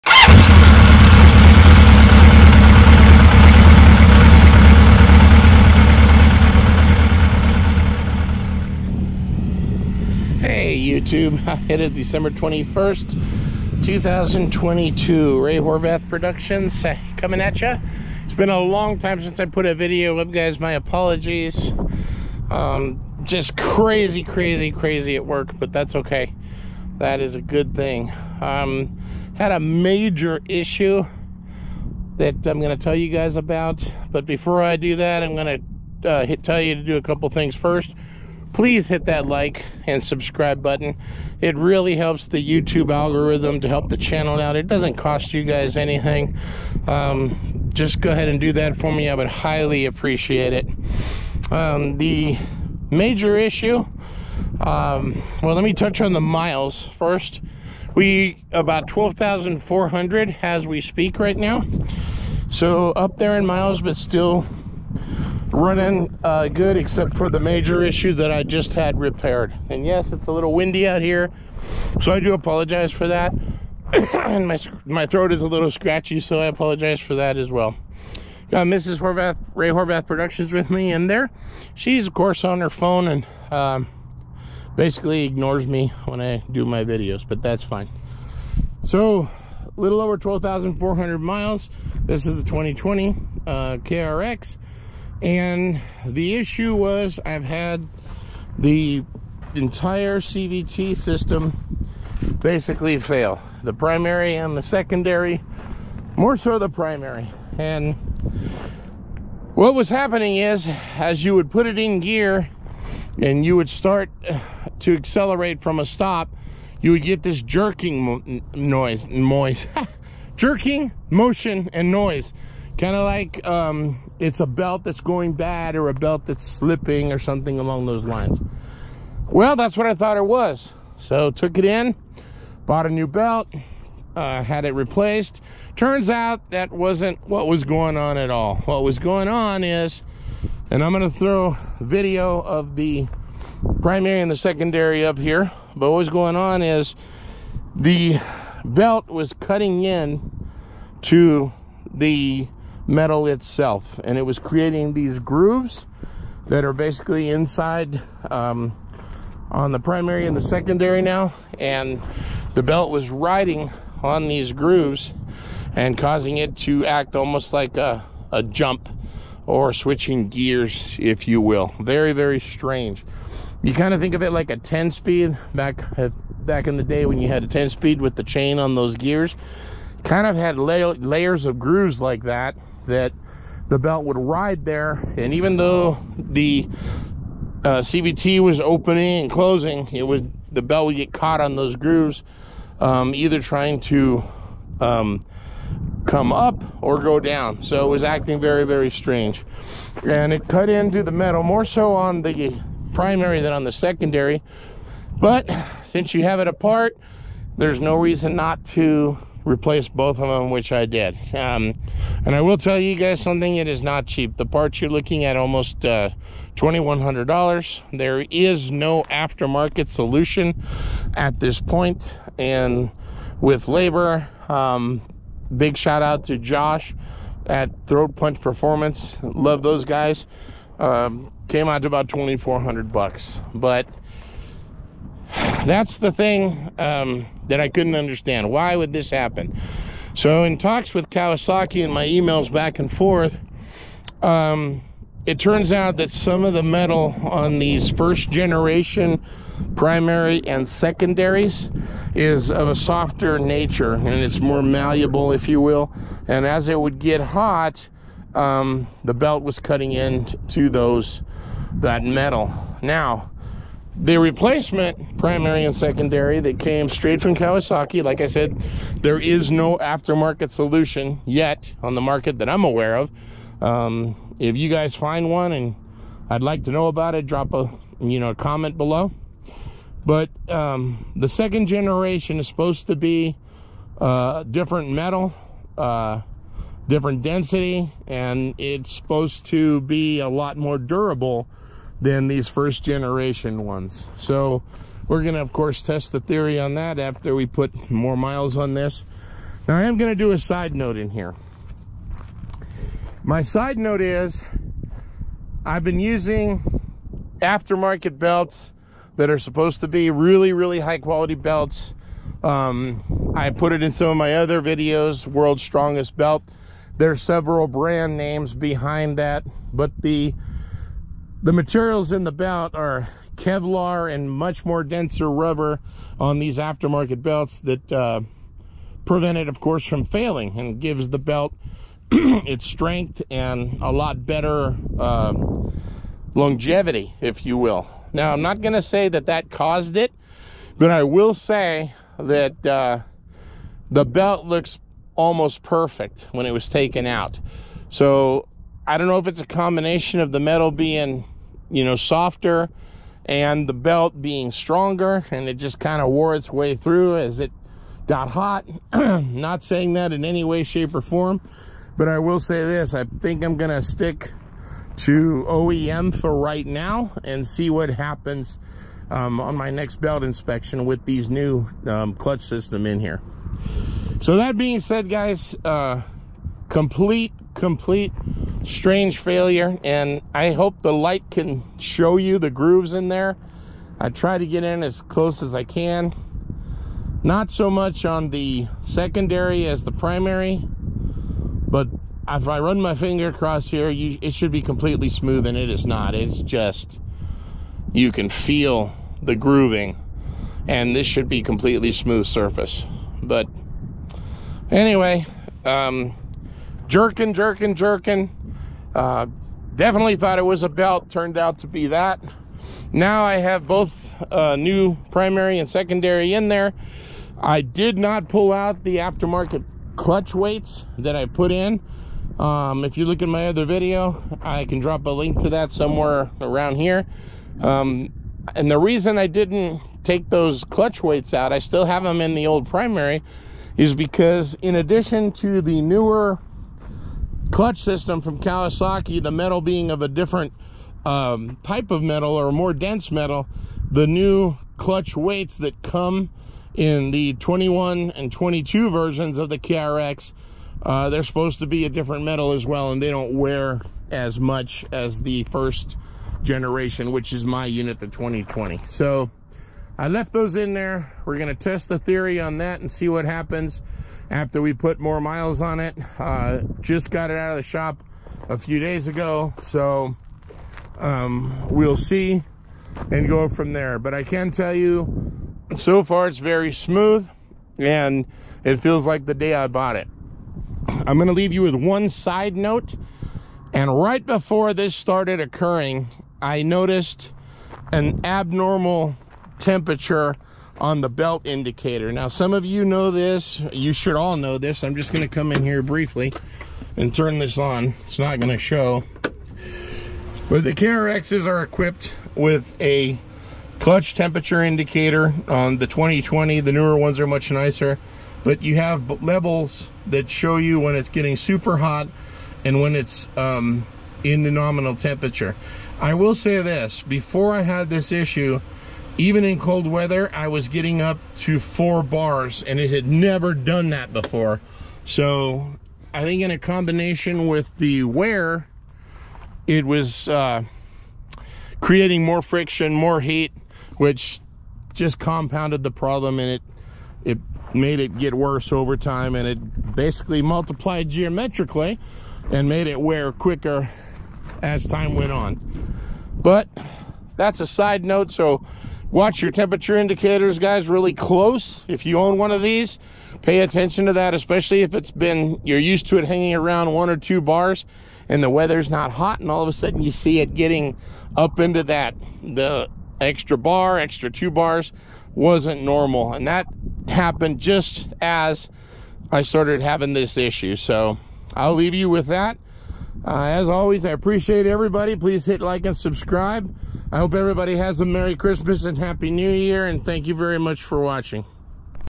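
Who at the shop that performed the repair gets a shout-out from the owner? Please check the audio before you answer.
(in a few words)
Josh.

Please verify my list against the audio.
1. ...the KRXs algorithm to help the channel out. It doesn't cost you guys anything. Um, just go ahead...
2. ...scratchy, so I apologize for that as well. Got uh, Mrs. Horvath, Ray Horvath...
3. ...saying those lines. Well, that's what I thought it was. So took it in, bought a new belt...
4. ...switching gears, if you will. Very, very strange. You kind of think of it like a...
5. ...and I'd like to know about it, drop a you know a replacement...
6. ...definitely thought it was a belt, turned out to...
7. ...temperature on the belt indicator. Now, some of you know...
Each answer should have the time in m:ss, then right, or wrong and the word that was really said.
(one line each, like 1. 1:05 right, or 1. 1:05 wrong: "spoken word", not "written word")
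1. 0:42 wrong: "YouTube", not "KRXs"
2. 1:15 right
3. 2:07 wrong: "along", not "saying"
4. 2:49 right
5. 4:35 wrong: "comment", not "replacement"
6. 6:49 right
7. 8:09 right.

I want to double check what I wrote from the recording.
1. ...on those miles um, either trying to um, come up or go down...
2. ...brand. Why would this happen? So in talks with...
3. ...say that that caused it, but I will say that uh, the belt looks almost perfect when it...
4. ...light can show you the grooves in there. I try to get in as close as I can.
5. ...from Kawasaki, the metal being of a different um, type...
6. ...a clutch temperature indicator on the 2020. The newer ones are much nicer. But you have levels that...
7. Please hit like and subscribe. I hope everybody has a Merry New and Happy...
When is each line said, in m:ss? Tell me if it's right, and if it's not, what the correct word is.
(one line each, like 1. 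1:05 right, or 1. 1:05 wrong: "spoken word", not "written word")
1. 3:11 wrong: "grooves", not "miles"
2. 3:57 wrong: "understand", not "brand"
3. 5:38 right
4. 6:20 right
5. 7:18 right
6. 8:22 right
7. 9:35 wrong: "Christmas", not "New".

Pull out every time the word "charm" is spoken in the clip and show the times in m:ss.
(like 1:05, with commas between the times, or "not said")
not said.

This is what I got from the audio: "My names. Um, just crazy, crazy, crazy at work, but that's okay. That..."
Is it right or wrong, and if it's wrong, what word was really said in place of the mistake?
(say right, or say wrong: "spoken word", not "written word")
wrong: "apologies", not "names".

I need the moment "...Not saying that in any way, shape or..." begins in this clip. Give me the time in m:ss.
5:58.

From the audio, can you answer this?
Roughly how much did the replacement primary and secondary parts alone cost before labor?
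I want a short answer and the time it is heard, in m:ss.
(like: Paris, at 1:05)
$2,100, at 3:36.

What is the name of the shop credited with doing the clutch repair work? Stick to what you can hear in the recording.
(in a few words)
Throat Punch Performance.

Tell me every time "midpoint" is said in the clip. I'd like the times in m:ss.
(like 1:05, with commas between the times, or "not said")
not said.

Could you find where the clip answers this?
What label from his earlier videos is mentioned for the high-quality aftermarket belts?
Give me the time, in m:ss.
5:15.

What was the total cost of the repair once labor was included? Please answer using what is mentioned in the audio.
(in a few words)
2,400.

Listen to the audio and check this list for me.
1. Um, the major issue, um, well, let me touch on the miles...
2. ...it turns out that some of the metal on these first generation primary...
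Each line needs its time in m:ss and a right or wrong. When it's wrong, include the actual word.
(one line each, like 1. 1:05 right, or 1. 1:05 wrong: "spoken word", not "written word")
1. 0:51 right
2. 4:05 right.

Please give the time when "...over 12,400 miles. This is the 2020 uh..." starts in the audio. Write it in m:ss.
1:30.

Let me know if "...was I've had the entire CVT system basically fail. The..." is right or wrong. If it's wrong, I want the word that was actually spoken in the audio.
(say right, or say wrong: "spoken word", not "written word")
right.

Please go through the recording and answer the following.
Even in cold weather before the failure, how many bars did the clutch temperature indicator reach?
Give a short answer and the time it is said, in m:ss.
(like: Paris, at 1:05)
4, at 8:41.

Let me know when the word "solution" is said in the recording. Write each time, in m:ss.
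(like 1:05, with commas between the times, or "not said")
3:39, 4:30.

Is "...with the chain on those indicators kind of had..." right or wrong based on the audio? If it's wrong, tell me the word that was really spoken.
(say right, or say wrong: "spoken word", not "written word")
wrong: "gears", not "indicators".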